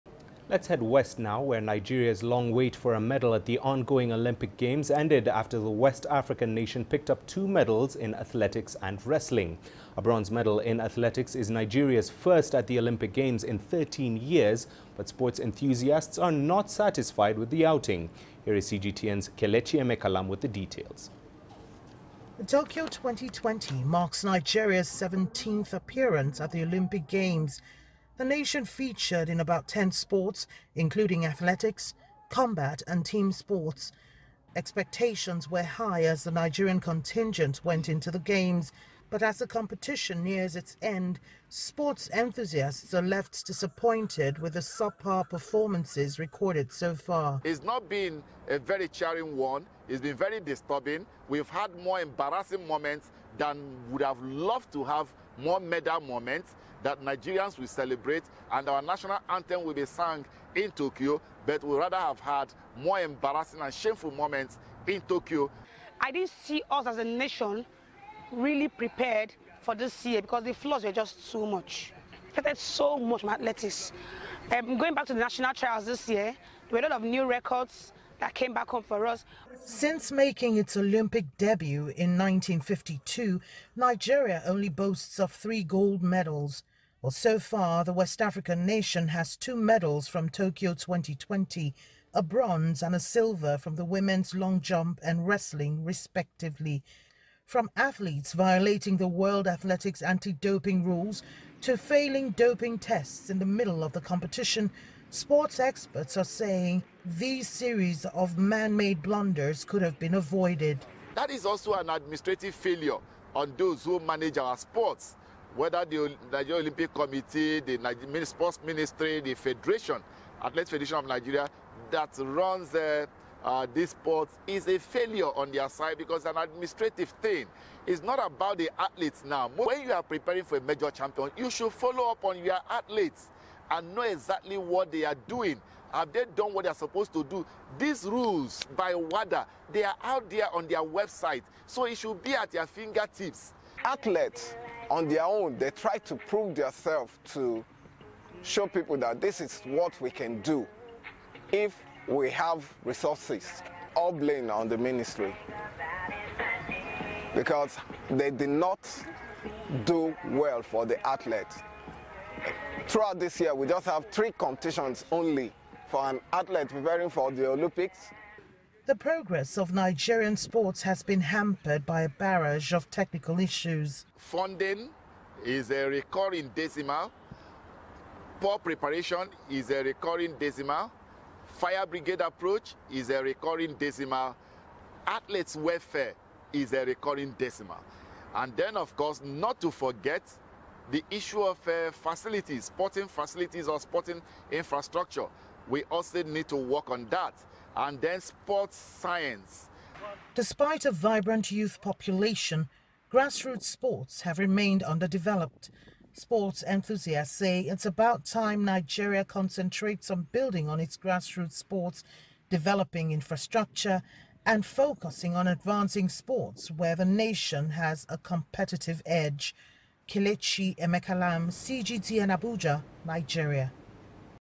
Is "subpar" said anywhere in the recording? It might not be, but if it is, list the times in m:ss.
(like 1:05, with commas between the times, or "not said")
0:44.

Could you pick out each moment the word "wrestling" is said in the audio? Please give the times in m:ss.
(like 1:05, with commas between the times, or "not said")
0:09, 1:35.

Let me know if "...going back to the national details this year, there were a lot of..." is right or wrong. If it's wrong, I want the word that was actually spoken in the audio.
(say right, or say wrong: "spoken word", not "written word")
wrong: "trials", not "details".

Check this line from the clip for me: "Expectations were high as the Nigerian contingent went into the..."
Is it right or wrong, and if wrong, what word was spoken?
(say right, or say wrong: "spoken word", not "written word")
right.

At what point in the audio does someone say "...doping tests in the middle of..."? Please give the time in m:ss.
1:42.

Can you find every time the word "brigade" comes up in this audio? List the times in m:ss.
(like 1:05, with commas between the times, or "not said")
3:01.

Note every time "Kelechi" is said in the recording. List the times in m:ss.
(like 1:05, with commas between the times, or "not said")
0:19, 3:40.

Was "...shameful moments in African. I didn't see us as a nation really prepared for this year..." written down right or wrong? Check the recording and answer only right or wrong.
wrong.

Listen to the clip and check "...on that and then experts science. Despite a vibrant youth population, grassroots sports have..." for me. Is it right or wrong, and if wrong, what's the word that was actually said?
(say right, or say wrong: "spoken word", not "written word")
wrong: "sports", not "experts".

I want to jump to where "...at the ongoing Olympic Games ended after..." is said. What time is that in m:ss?
0:03.